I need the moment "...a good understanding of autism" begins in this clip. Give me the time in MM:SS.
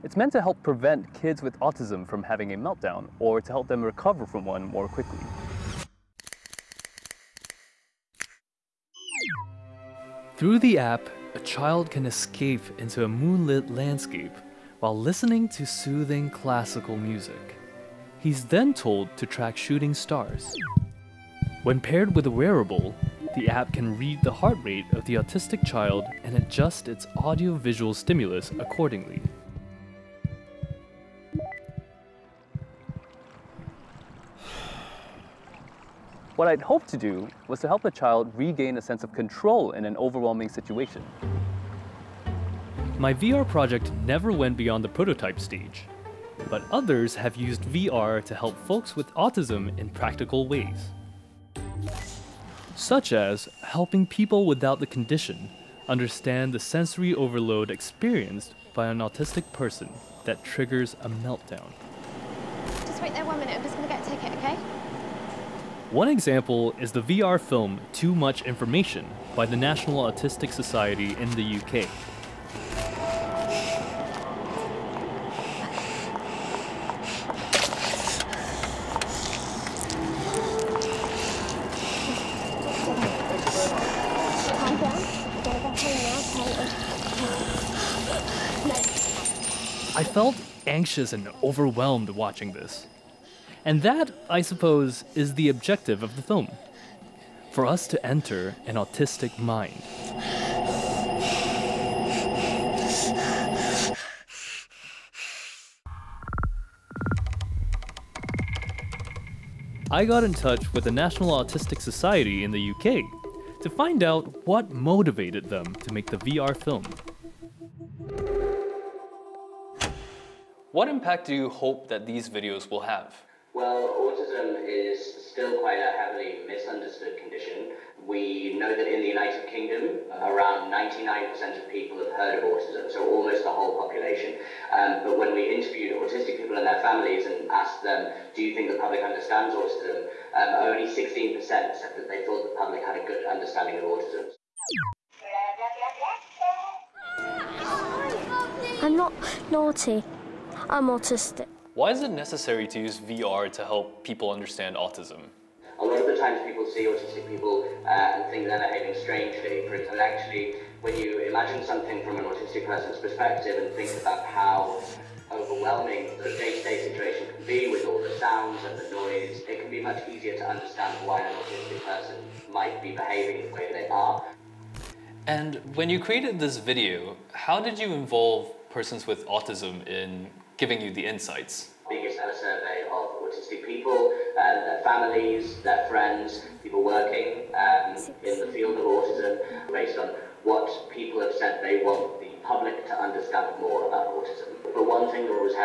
02:23.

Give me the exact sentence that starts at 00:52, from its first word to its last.
Such as helping people without the condition understand the sensory overload experienced by an autistic person that triggers a meltdown.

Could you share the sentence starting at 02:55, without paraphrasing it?
And when you created this video, how did you involve persons with autism in giving you the insights.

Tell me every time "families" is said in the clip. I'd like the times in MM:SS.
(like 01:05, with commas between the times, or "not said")
02:16, 03:04.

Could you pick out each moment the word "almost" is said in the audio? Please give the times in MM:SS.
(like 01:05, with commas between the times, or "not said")
02:13.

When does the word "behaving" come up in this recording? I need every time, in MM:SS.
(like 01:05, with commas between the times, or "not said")
02:38, 02:53.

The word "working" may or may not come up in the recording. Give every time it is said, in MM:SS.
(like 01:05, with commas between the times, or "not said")
03:06.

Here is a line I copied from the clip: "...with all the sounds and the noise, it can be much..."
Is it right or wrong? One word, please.
right.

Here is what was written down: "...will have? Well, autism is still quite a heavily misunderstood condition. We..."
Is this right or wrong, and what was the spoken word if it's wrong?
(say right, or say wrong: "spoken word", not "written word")
right.